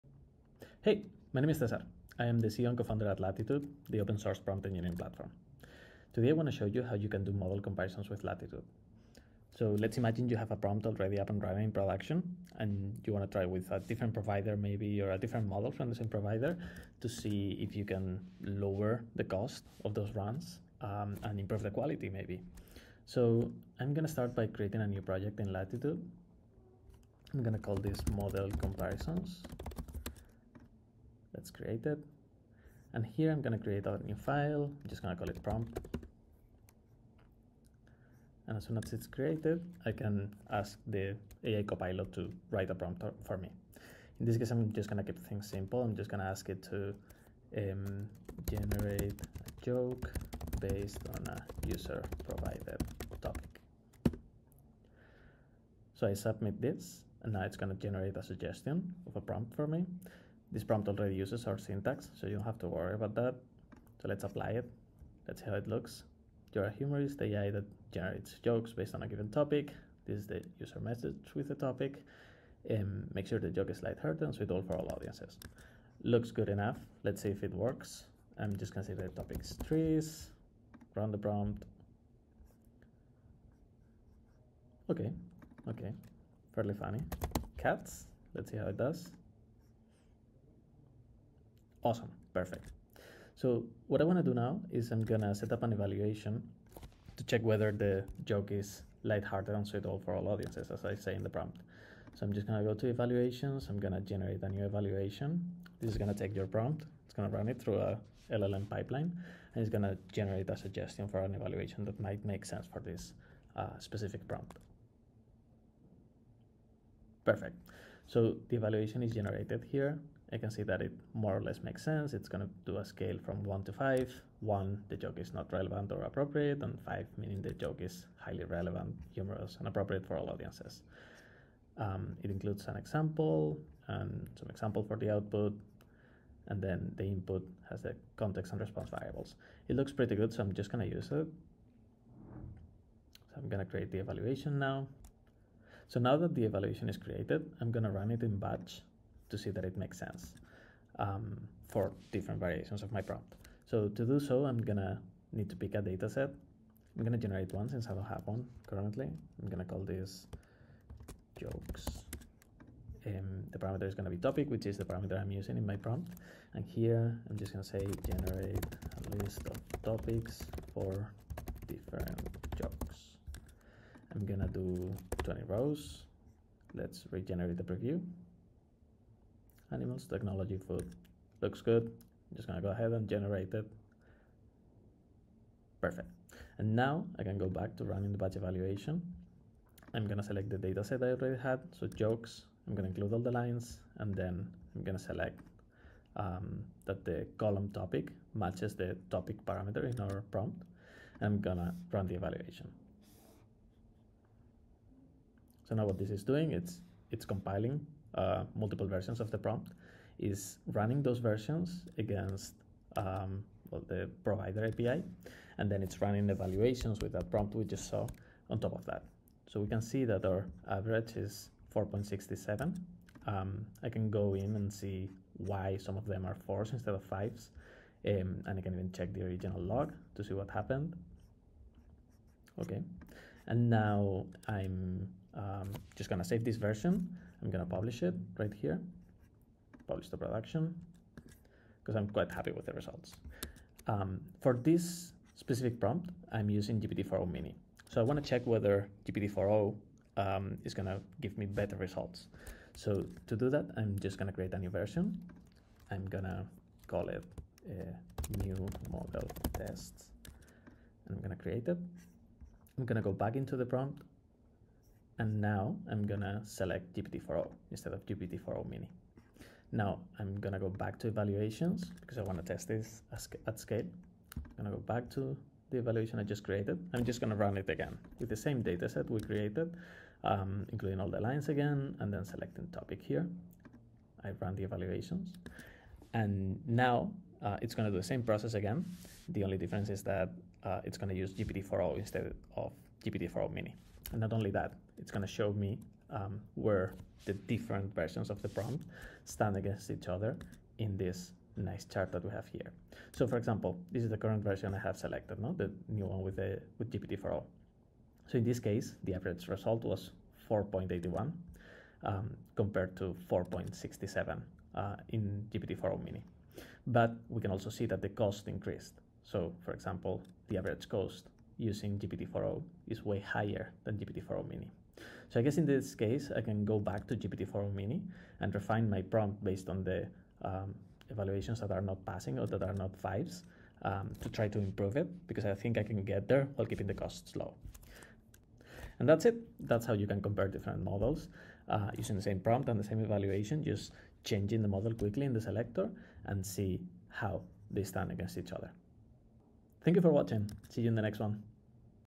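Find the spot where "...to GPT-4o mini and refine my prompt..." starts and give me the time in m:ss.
5:27.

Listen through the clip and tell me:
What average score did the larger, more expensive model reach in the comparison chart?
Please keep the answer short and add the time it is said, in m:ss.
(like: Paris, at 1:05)
4.81, at 5:10.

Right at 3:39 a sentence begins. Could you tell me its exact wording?
So we can see that our average is 4.67.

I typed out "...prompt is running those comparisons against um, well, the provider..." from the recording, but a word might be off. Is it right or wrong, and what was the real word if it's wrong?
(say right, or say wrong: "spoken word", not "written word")
wrong: "versions", not "comparisons".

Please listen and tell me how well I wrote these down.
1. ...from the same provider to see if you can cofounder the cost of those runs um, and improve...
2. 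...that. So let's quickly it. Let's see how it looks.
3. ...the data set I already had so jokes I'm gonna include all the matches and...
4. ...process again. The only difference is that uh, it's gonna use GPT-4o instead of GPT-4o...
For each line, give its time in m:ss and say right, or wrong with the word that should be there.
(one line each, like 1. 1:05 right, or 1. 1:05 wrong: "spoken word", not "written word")
1. 0:15 wrong: "lower", not "cofounder"
2. 1:03 wrong: "apply", not "quickly"
3. 3:10 wrong: "lines", not "matches"
4. 4:48 right.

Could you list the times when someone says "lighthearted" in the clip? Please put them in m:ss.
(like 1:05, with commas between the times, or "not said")
1:13, 1:39.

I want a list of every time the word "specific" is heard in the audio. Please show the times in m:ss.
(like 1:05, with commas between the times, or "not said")
1:53, 4:05.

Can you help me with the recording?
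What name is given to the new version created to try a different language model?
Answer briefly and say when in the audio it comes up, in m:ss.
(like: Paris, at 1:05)
new model test, at 4:17.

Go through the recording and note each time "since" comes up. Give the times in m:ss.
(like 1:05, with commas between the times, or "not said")
2:37.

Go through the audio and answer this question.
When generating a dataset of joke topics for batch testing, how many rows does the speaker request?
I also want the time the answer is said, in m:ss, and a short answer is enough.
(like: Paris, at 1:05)
20, at 2:55.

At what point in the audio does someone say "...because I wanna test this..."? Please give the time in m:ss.
4:32.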